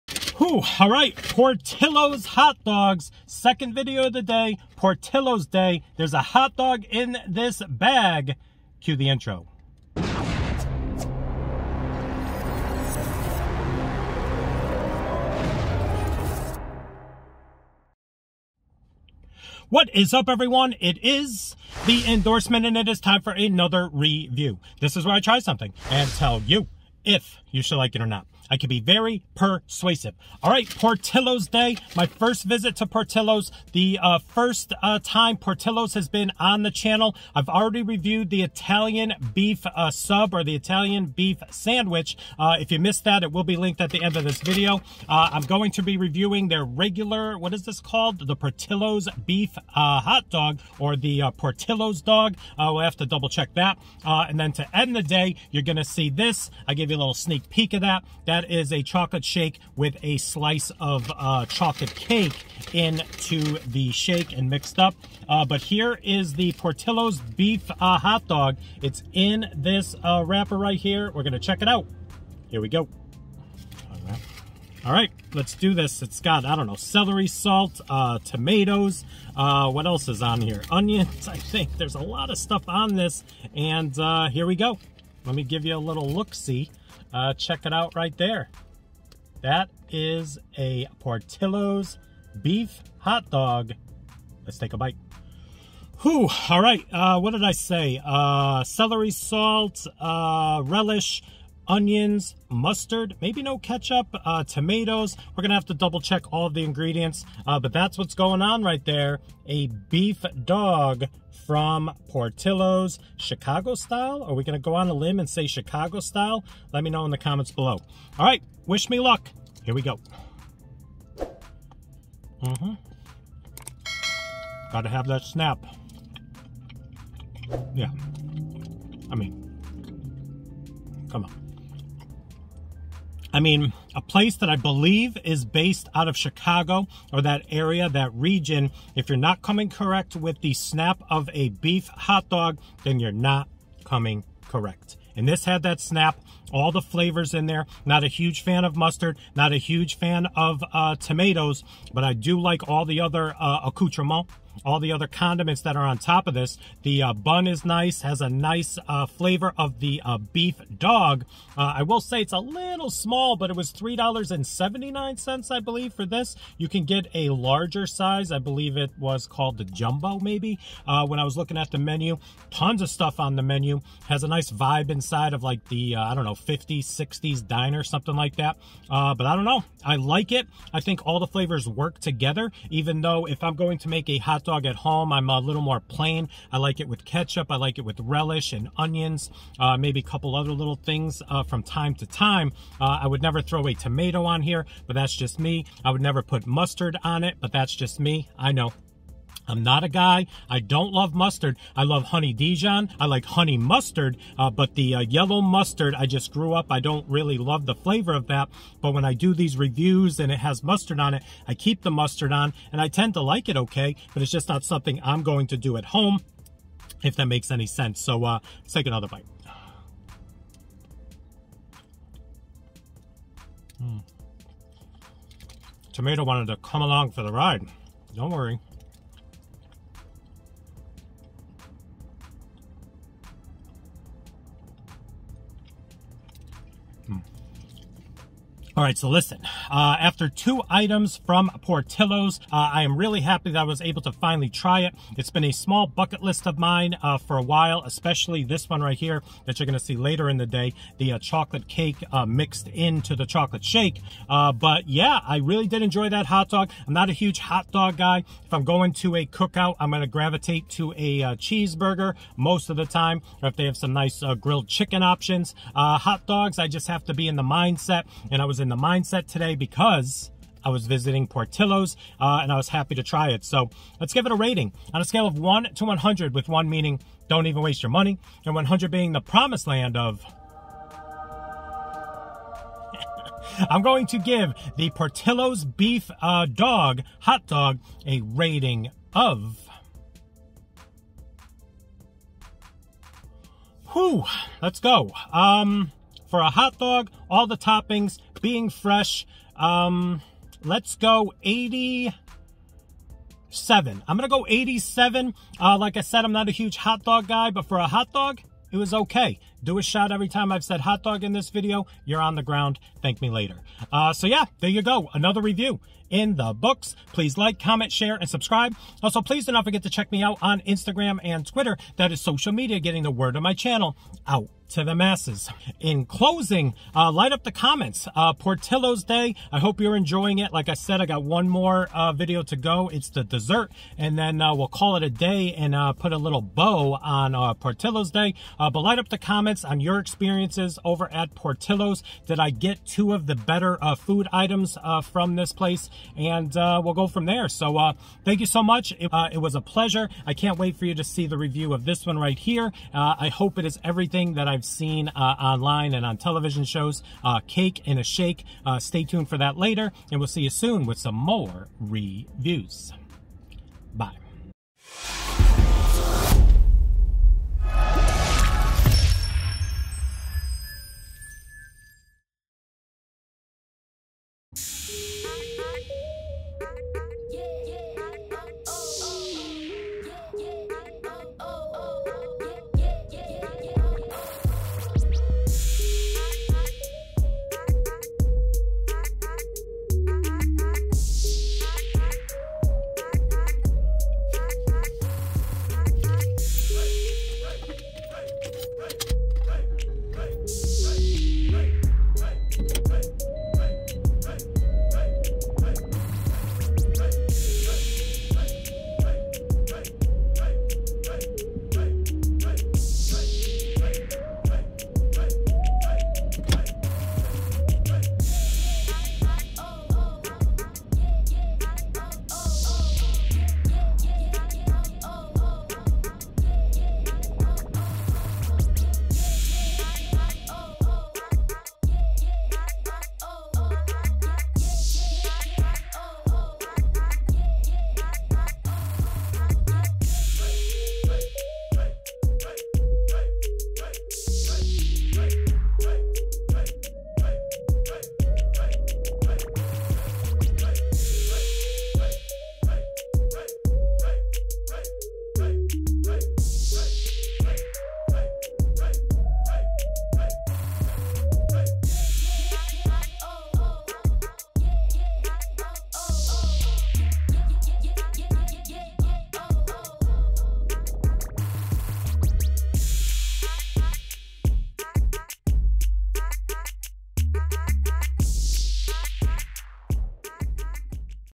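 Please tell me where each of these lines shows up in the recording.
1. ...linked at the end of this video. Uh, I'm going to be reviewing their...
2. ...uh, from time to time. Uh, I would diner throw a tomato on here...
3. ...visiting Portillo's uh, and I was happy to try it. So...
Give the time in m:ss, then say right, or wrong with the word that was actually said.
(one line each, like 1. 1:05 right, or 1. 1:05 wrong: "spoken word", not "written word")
1. 0:43 right
2. 3:11 wrong: "never", not "diner"
3. 4:30 right.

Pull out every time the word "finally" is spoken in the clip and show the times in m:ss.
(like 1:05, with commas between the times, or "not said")
4:04.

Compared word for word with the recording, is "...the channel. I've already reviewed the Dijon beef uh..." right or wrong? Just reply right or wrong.
wrong.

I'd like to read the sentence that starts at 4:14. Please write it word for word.
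Uh, but yeah, I really did enjoy that hot dog.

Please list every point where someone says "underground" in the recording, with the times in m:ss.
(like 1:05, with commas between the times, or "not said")
not said.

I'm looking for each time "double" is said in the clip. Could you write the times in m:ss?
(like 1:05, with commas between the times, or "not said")
0:53, 1:45.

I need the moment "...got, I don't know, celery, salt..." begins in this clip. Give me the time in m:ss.
1:16.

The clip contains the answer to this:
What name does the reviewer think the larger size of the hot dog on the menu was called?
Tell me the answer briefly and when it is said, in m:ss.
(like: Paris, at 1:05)
Jumbo, at 2:49.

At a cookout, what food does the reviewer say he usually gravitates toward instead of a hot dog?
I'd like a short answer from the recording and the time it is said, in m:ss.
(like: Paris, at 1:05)
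Cheeseburger, at 4:21.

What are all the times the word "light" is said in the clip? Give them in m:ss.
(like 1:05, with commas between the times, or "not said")
5:27, 5:38.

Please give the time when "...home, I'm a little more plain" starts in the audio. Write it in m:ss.
3:04.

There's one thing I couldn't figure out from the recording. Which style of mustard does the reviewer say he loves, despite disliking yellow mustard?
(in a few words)
Honey Dijon.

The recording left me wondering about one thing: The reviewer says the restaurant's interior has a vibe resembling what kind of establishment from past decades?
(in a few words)
50s, 60s diner.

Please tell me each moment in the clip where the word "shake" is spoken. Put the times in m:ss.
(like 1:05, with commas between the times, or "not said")
0:59, 1:03, 4:13, 5:58.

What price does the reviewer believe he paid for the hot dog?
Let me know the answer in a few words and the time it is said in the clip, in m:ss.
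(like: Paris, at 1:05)
$3.79, at 2:43.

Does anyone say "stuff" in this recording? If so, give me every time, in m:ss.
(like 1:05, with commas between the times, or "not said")
1:22, 2:52.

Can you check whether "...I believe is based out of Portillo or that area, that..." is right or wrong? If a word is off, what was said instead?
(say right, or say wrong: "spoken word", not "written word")
wrong: "Chicago", not "Portillo".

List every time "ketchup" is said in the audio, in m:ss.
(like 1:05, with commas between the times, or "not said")
1:43, 3:07.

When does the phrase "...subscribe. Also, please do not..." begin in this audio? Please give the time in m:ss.
5:18.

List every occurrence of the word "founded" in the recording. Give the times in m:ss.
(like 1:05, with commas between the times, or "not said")
not said.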